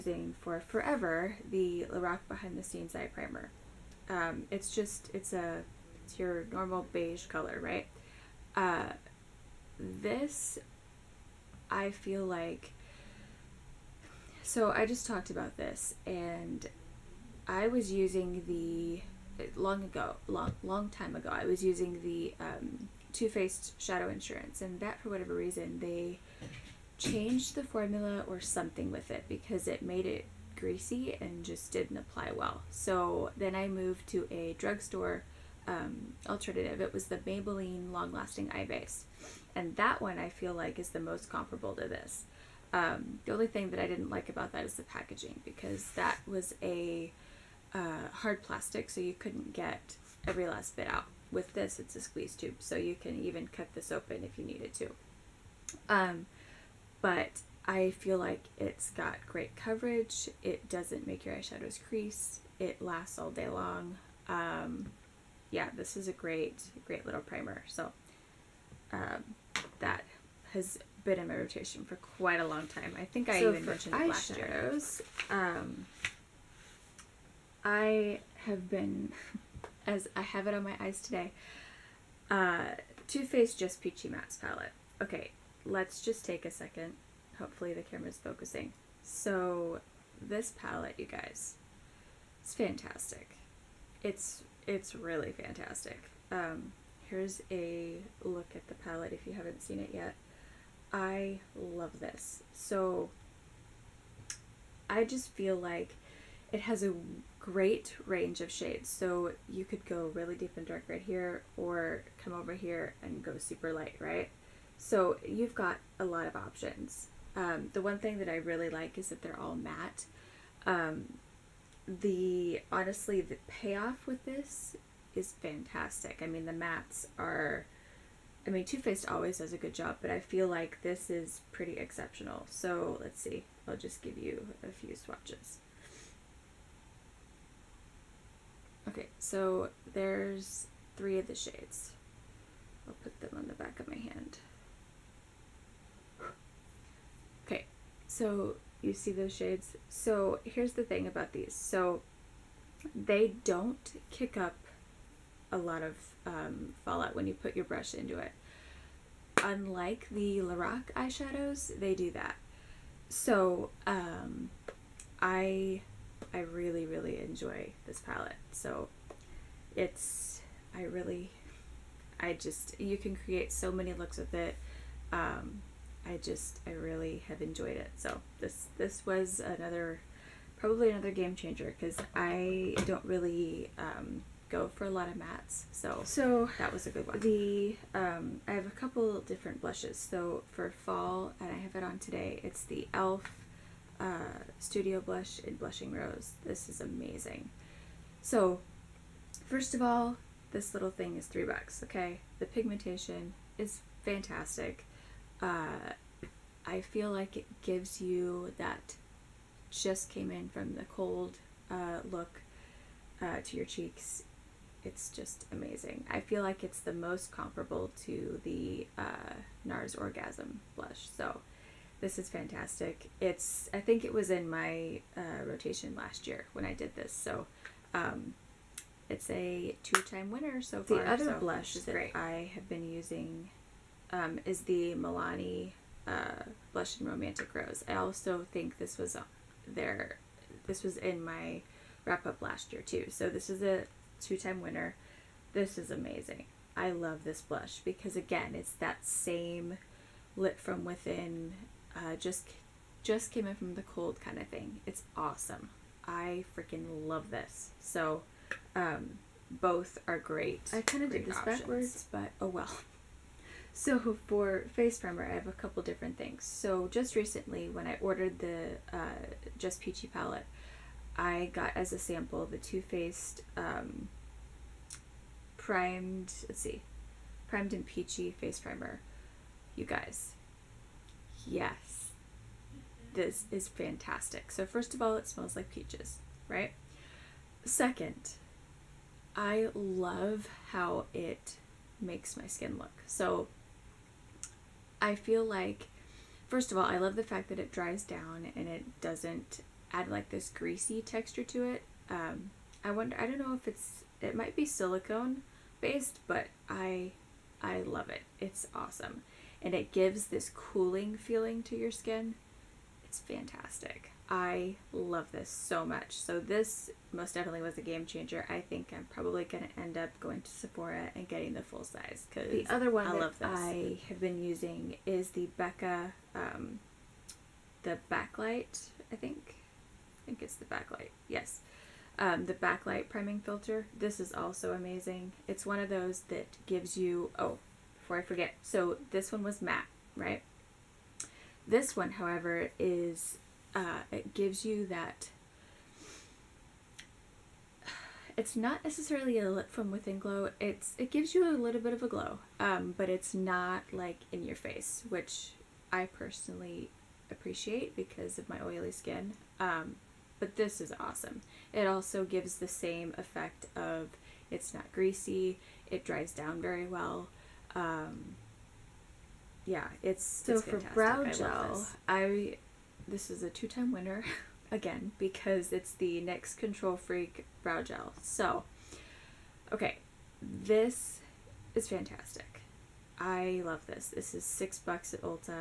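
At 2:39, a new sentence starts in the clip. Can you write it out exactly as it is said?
Unlike the Lorac eyeshadows, they do that.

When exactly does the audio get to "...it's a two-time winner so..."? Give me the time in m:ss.
3:49.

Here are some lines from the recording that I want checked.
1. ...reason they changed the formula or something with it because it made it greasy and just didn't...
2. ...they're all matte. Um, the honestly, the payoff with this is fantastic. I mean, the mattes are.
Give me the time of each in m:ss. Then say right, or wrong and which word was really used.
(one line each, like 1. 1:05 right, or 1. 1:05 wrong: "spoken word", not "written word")
1. 0:25 right
2. 1:59 right.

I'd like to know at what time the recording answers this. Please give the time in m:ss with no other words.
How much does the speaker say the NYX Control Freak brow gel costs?
6:24.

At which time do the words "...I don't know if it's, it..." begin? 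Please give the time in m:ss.
5:03.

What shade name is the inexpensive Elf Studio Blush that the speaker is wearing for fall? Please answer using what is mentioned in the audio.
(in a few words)
Blushing Rose.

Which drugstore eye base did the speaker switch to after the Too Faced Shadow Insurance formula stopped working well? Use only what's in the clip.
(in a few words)
Maybelline Long Lasting Eye Base.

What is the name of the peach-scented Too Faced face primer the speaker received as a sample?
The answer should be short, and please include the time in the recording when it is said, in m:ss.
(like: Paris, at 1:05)
Primed and Peachy, at 4:37.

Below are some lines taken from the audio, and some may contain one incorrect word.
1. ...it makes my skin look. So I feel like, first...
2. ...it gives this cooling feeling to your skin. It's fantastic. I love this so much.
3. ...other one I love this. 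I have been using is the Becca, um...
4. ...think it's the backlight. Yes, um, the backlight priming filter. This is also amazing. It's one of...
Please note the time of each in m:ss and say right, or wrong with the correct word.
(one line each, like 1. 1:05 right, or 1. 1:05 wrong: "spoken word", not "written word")
1. 4:51 right
2. 5:09 right
3. 5:22 right
4. 5:30 right.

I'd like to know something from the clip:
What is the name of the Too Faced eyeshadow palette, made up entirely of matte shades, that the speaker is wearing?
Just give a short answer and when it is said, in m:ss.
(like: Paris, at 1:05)
Just Peachy Mattes, at 1:23.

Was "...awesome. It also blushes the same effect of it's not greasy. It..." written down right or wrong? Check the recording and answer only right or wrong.
wrong.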